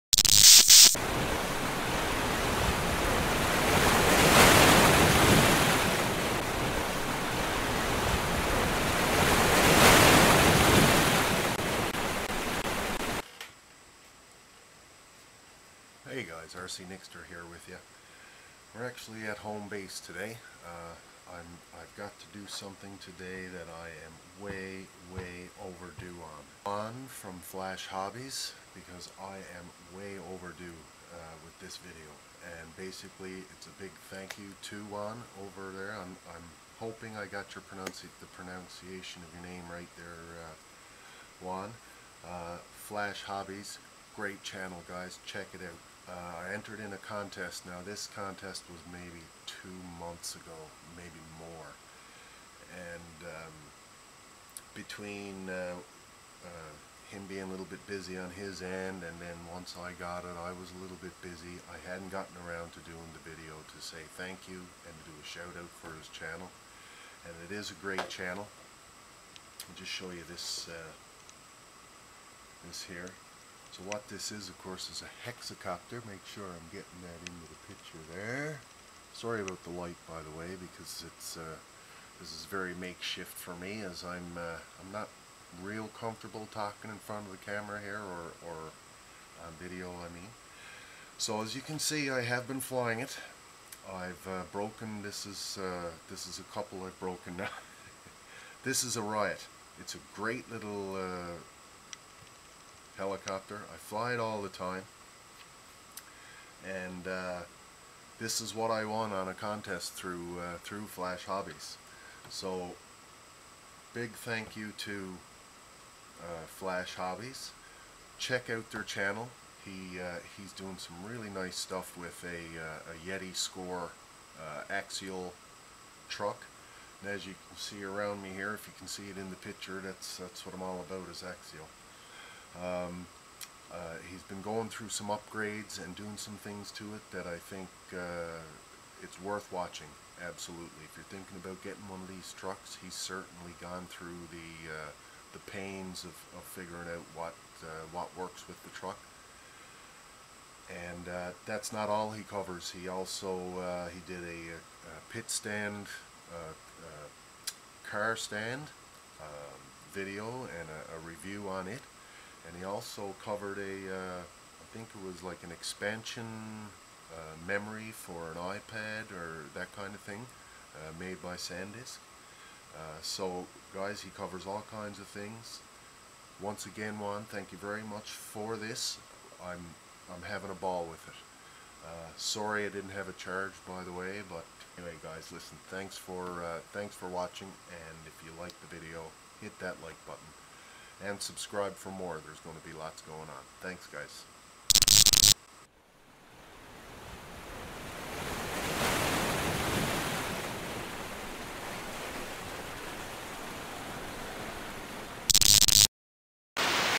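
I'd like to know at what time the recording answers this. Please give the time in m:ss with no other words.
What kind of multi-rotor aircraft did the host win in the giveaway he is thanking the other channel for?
1:15.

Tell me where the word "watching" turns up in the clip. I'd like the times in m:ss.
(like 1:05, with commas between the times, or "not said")
2:19, 3:07.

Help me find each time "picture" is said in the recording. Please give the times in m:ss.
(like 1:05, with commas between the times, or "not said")
1:17, 2:09.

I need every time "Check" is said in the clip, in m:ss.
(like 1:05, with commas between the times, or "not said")
0:45, 1:58.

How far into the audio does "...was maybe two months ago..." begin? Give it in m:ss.
0:48.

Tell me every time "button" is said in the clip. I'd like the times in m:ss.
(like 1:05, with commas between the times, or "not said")
3:10.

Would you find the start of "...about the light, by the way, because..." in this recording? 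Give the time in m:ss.
1:19.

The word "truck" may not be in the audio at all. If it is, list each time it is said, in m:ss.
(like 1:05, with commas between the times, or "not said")
2:06, 2:22, 2:28.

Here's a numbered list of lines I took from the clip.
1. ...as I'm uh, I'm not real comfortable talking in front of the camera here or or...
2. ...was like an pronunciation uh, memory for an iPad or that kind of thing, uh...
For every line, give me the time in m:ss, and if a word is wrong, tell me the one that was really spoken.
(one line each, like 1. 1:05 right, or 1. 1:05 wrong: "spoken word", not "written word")
1. 1:23 right
2. 2:45 wrong: "expansion", not "pronunciation".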